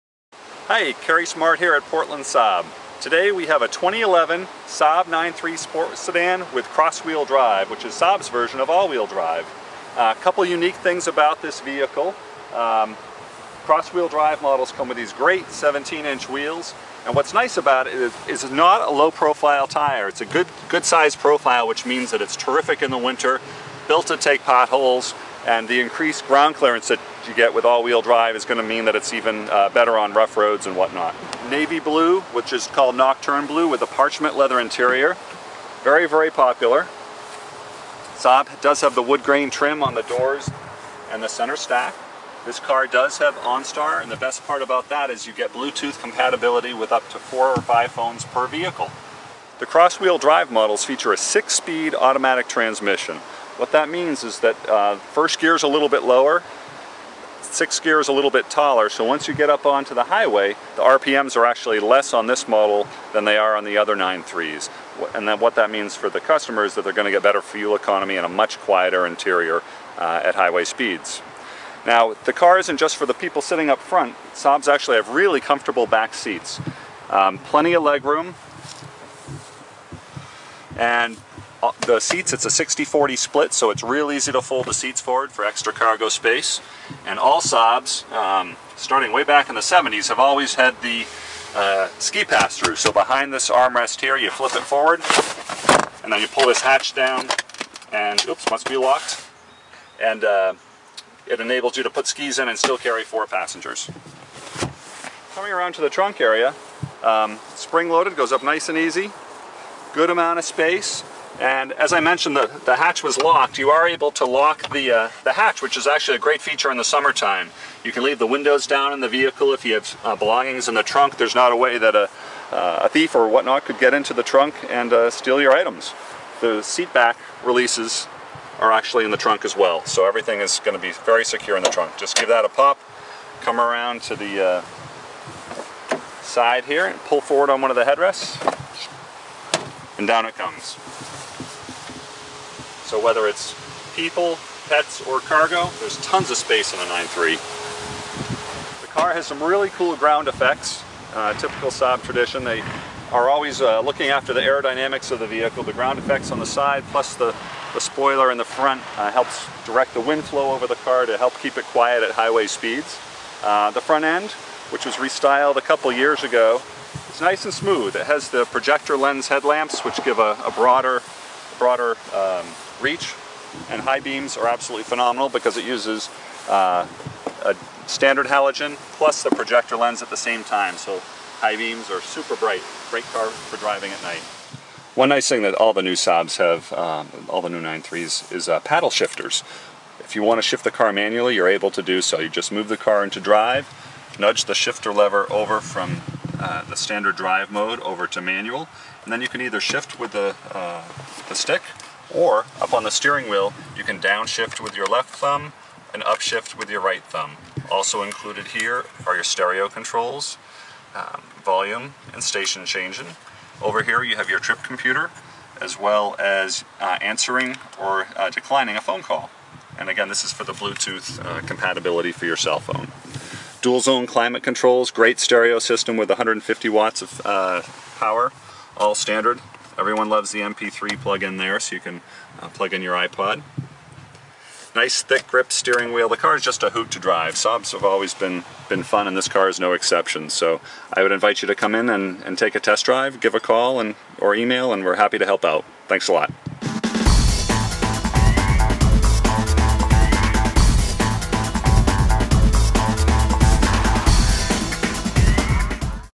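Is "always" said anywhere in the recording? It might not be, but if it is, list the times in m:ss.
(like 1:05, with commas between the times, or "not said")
1:30, 2:33, 3:57.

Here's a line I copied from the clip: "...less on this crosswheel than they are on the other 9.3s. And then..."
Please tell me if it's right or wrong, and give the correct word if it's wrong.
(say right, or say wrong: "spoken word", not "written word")
wrong: "model", not "crosswheel".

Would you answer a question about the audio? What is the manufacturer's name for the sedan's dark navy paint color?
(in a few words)
Nocturne Blue.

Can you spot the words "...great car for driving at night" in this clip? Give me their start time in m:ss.
3:02.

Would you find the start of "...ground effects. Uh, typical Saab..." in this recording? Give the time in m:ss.
2:29.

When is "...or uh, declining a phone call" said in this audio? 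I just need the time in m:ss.
3:37.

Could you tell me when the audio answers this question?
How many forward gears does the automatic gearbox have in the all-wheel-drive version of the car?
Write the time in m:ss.
0:51.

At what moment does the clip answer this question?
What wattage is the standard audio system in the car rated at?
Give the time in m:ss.
3:46.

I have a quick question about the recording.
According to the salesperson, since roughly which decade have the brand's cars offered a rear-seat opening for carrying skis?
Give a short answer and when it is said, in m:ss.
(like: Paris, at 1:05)
1970s, at 1:29.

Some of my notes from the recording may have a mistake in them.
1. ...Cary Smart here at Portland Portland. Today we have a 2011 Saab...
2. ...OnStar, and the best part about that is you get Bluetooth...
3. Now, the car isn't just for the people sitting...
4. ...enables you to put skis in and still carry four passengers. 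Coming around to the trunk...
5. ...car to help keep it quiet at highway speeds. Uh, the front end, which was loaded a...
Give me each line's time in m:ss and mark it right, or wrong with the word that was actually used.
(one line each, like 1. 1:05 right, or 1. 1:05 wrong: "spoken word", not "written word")
1. 0:00 wrong: "Saab", not "Portland"
2. 0:43 right
3. 1:11 right
4. 1:41 right
5. 2:40 wrong: "restyled", not "loaded".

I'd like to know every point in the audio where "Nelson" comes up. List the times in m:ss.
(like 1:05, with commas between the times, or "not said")
not said.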